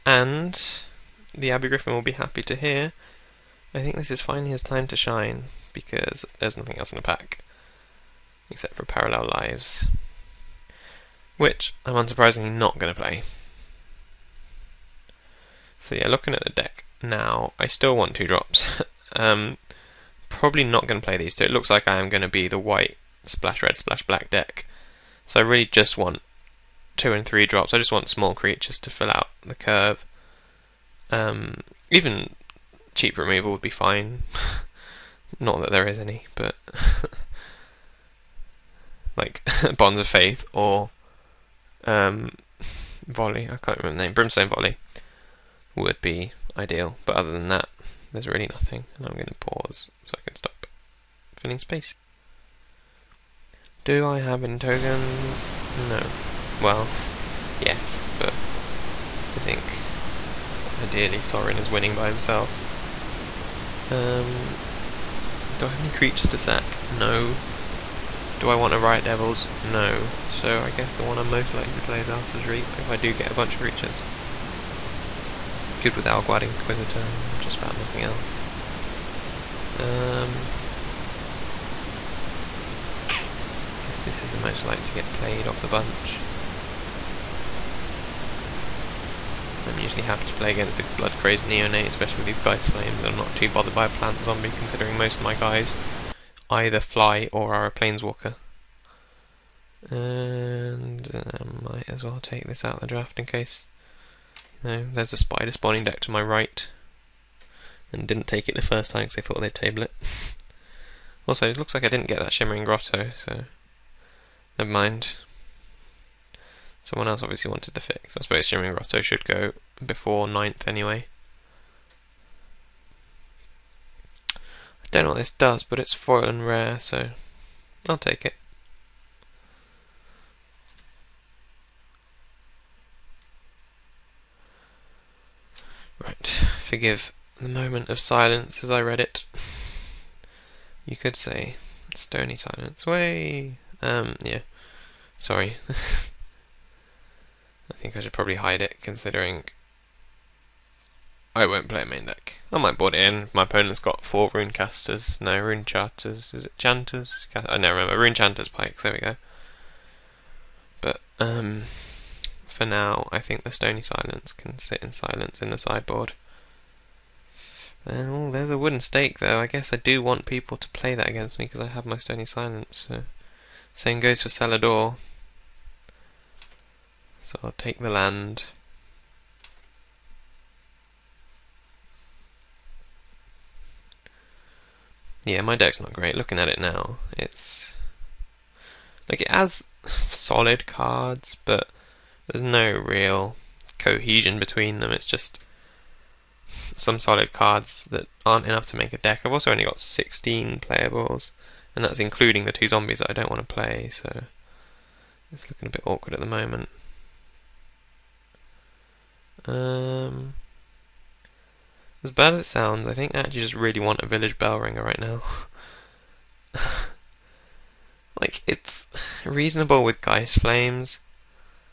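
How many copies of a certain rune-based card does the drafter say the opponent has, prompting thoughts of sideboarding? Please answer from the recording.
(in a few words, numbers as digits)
4.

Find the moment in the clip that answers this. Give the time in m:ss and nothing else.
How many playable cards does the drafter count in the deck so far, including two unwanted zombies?
3:19.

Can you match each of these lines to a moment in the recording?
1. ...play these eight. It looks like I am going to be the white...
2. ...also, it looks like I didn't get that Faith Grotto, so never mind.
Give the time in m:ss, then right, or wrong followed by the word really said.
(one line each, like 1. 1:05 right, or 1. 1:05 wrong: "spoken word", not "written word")
1. 0:21 wrong: "two", not "eight"
2. 1:51 wrong: "Shimmering", not "Faith".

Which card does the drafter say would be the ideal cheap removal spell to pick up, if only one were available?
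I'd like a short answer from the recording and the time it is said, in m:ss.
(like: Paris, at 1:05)
Brimstone Volley, at 0:44.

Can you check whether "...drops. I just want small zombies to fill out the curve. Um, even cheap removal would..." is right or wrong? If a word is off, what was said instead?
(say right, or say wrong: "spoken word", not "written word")
wrong: "creatures", not "zombies".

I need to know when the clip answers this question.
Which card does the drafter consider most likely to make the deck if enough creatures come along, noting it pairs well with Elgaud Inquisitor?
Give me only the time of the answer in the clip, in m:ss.
1:12.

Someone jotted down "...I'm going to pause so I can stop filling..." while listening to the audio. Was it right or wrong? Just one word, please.
right.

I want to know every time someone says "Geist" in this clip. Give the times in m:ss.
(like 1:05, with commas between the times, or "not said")
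1:32, 3:39.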